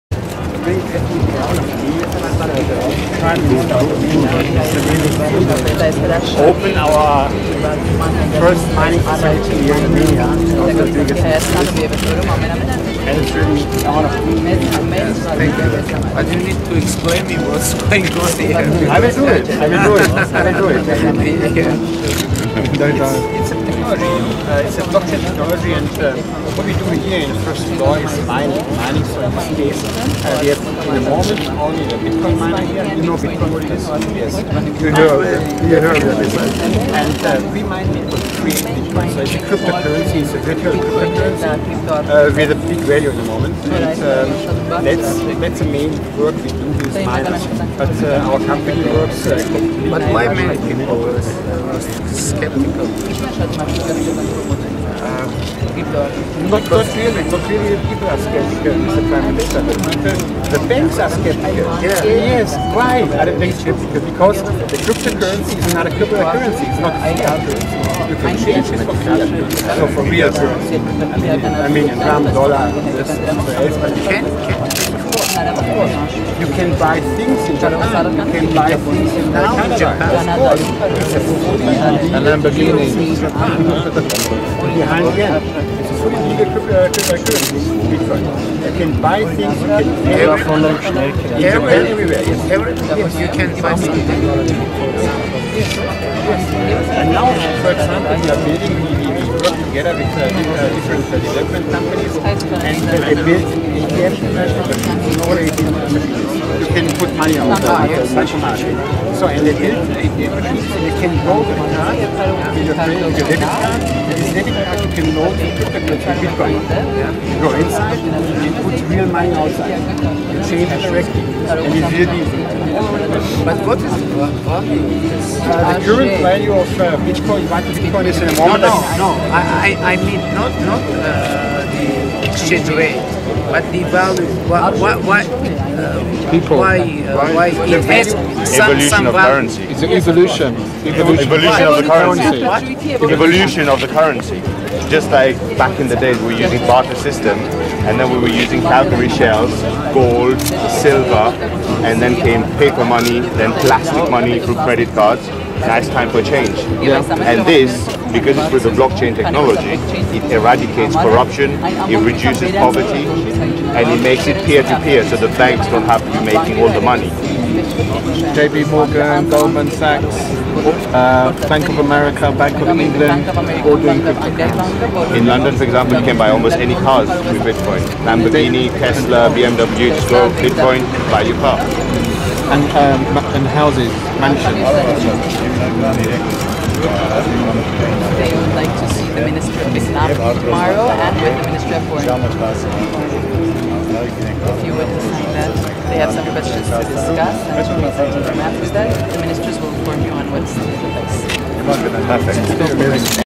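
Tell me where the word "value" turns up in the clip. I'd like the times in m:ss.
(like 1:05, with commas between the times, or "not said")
0:42, 2:06, 2:13.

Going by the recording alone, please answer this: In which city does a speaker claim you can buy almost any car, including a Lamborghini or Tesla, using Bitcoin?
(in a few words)
London.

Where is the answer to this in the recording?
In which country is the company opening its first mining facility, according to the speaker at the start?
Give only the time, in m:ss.
0:09.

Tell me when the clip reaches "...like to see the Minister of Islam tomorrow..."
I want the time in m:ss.
3:08.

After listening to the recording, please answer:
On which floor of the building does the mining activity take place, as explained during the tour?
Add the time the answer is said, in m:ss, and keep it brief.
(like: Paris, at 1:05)
First floor, at 0:27.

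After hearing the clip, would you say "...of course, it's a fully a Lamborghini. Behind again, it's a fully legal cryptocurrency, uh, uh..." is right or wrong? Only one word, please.
right.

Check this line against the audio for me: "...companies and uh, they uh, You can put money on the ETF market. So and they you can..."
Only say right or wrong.
right.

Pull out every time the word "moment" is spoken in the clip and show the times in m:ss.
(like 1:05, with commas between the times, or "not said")
0:31, 0:43, 2:08.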